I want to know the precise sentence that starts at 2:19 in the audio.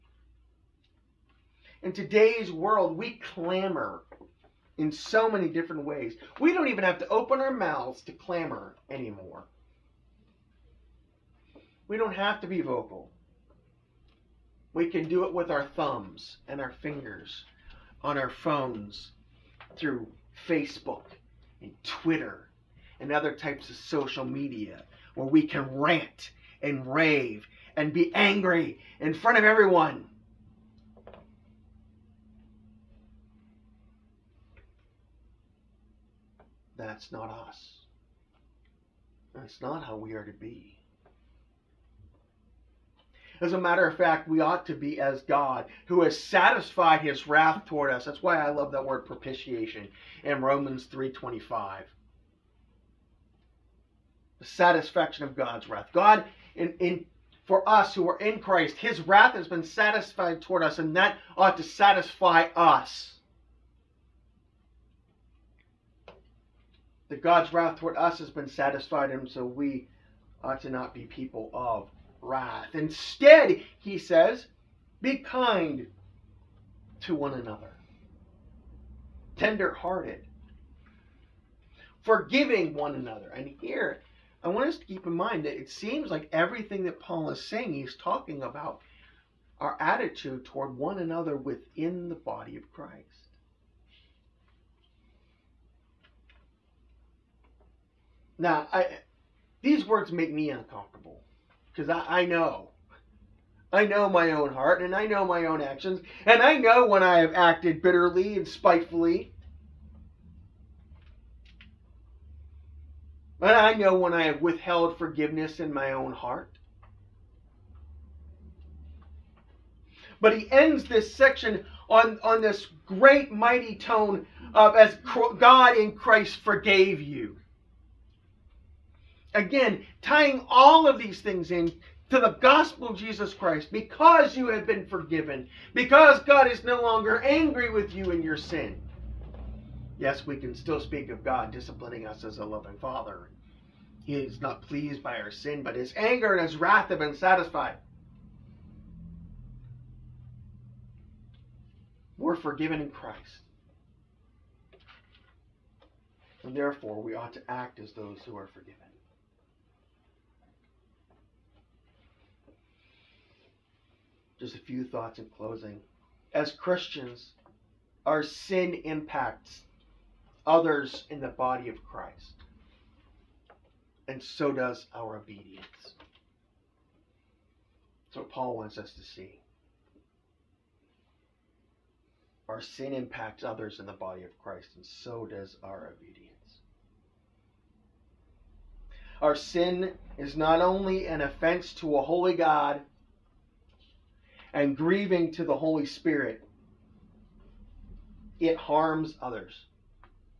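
Yes, we can still speak of God disciplining us as a loving father.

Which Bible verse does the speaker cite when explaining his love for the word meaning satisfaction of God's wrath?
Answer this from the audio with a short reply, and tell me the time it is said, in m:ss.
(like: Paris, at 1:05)
Romans 3:25, at 0:50.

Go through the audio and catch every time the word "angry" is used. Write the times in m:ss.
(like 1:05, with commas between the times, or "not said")
0:28, 2:17.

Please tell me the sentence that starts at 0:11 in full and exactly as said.
We don't have to be vocal.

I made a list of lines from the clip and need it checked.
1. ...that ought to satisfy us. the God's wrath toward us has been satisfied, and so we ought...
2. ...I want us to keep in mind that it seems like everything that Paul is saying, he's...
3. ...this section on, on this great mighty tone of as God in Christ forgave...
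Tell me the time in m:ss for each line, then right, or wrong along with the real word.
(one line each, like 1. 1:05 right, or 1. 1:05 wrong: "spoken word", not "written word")
1. 1:00 right
2. 1:24 right
3. 2:00 right.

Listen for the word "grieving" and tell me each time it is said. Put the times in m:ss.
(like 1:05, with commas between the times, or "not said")
3:14.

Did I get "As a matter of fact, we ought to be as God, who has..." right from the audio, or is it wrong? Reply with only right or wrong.
right.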